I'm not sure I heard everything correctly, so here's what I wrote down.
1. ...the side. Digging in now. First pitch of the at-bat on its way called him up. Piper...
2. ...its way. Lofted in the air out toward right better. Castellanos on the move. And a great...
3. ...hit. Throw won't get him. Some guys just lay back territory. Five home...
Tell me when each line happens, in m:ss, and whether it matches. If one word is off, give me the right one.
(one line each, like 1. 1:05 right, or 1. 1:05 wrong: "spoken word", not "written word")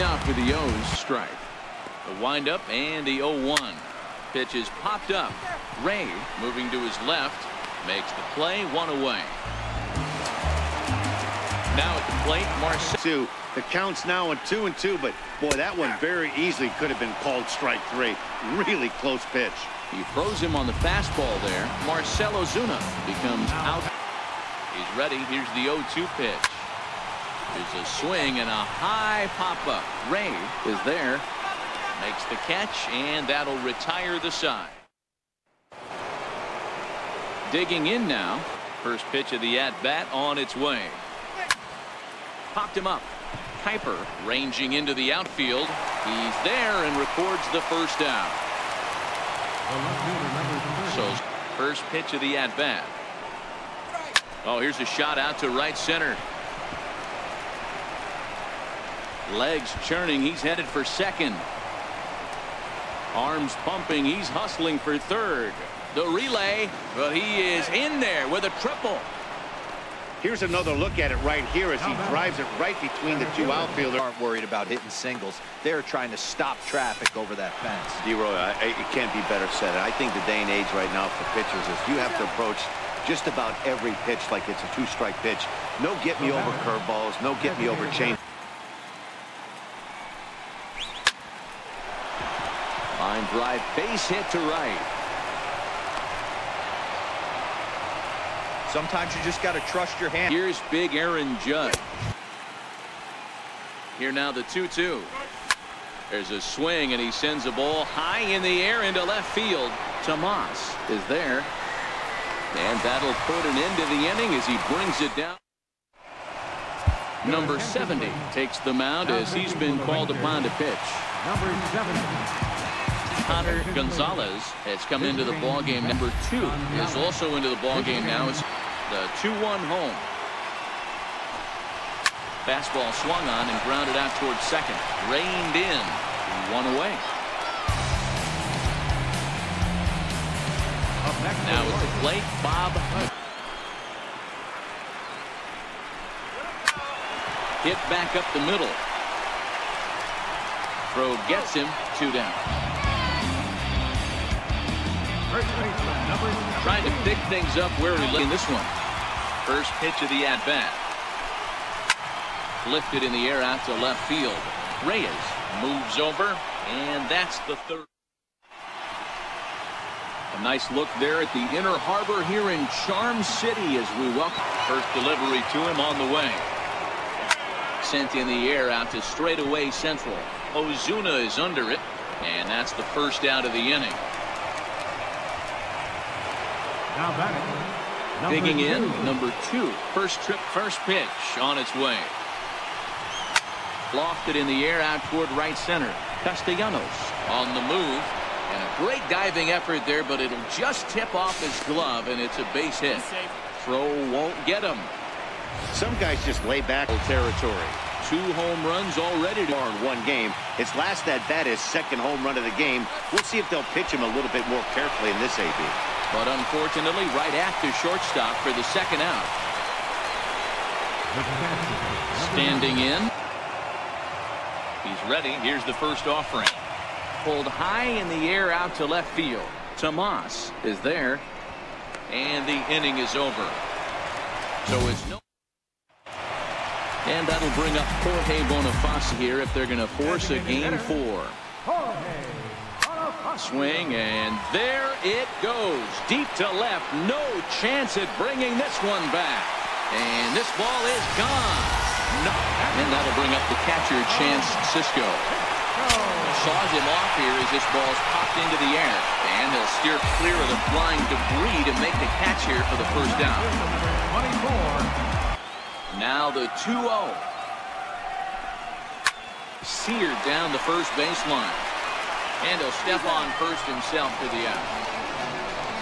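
1. 0:34 wrong: "popped", not "called"
2. 3:11 wrong: "center", not "better"
3. 3:22 wrong: "Two", not "Five".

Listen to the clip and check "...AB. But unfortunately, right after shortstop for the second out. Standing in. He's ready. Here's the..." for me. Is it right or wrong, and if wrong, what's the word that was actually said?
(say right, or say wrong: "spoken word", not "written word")
right.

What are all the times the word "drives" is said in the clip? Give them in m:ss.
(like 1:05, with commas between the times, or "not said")
1:12, 1:33.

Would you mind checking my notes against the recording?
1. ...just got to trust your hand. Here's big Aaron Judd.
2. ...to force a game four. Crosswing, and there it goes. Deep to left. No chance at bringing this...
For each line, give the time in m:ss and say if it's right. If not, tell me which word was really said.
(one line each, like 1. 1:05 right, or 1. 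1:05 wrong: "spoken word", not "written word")
1. 1:39 right
2. 3:59 right.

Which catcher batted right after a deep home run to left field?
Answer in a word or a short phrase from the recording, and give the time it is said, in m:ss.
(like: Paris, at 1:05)
Chance Sisco, at 4:14.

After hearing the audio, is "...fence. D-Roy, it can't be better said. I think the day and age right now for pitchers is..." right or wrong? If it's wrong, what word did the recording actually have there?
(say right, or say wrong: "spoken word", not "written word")
right.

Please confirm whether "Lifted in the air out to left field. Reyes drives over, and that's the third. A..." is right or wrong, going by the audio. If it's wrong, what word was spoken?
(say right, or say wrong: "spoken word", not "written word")
wrong: "moves", not "drives".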